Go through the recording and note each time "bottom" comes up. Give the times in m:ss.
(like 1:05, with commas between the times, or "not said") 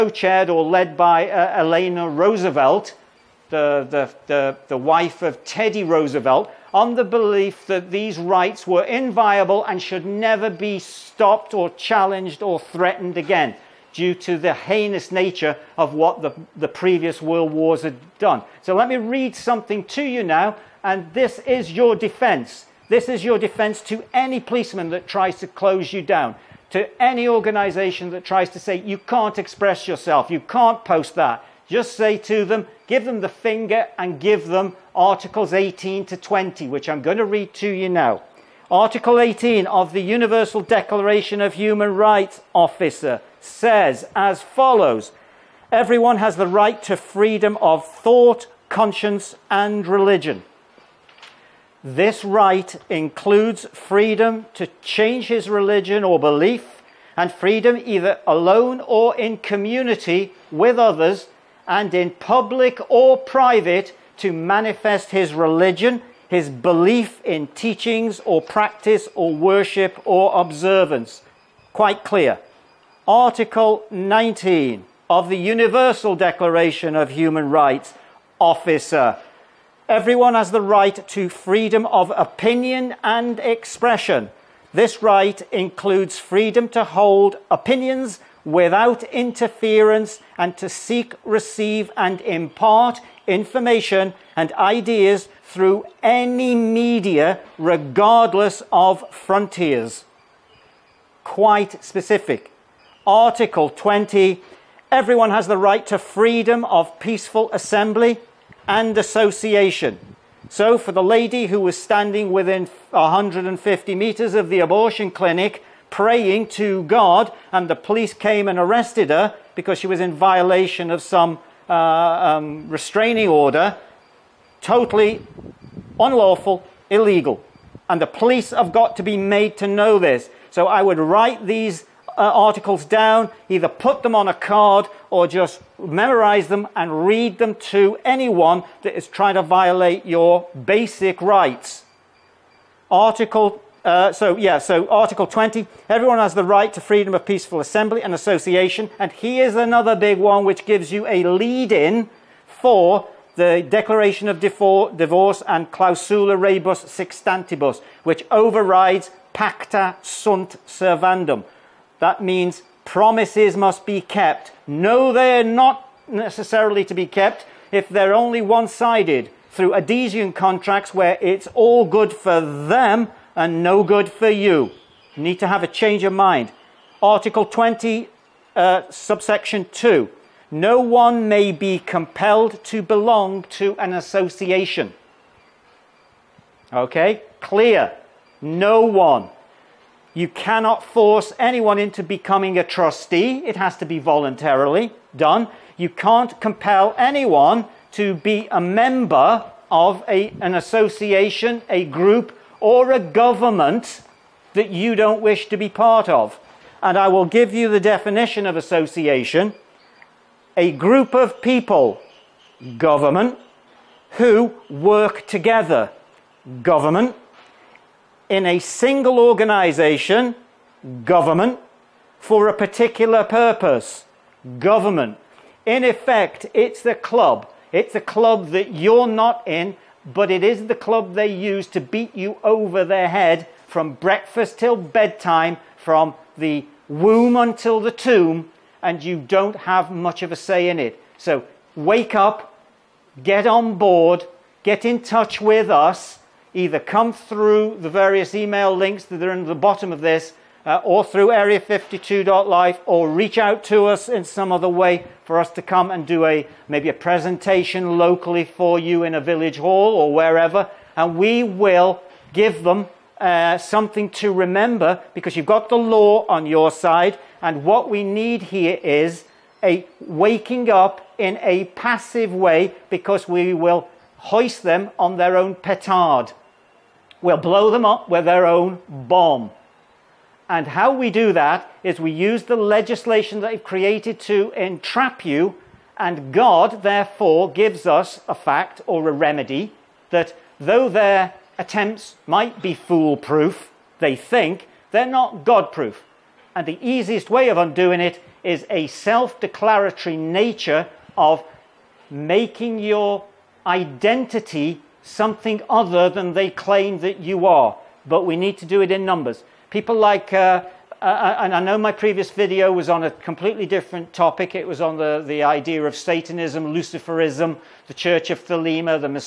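4:09.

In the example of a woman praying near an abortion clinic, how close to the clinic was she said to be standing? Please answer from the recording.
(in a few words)
150 metres.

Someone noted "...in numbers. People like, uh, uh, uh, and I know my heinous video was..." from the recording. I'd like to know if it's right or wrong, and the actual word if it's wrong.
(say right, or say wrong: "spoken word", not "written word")
wrong: "previous", not "heinous".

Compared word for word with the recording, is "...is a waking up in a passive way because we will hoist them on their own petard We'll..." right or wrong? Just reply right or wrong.
right.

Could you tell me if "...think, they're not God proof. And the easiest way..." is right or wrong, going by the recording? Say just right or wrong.
right.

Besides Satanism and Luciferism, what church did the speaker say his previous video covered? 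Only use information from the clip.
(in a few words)
Church of Thelema.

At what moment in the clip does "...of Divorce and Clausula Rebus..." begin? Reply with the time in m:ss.
2:34.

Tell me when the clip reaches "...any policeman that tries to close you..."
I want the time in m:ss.
0:24.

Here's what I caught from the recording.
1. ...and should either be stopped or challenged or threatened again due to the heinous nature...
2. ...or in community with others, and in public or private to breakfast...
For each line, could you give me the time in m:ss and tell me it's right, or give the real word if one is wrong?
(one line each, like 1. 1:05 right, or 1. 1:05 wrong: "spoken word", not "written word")
1. 0:09 wrong: "never", not "either"
2. 0:58 wrong: "manifest", not "breakfast".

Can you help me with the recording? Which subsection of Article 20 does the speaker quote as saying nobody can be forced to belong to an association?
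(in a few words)
Subsection 2.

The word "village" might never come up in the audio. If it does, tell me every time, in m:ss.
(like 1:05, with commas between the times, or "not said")
4:19.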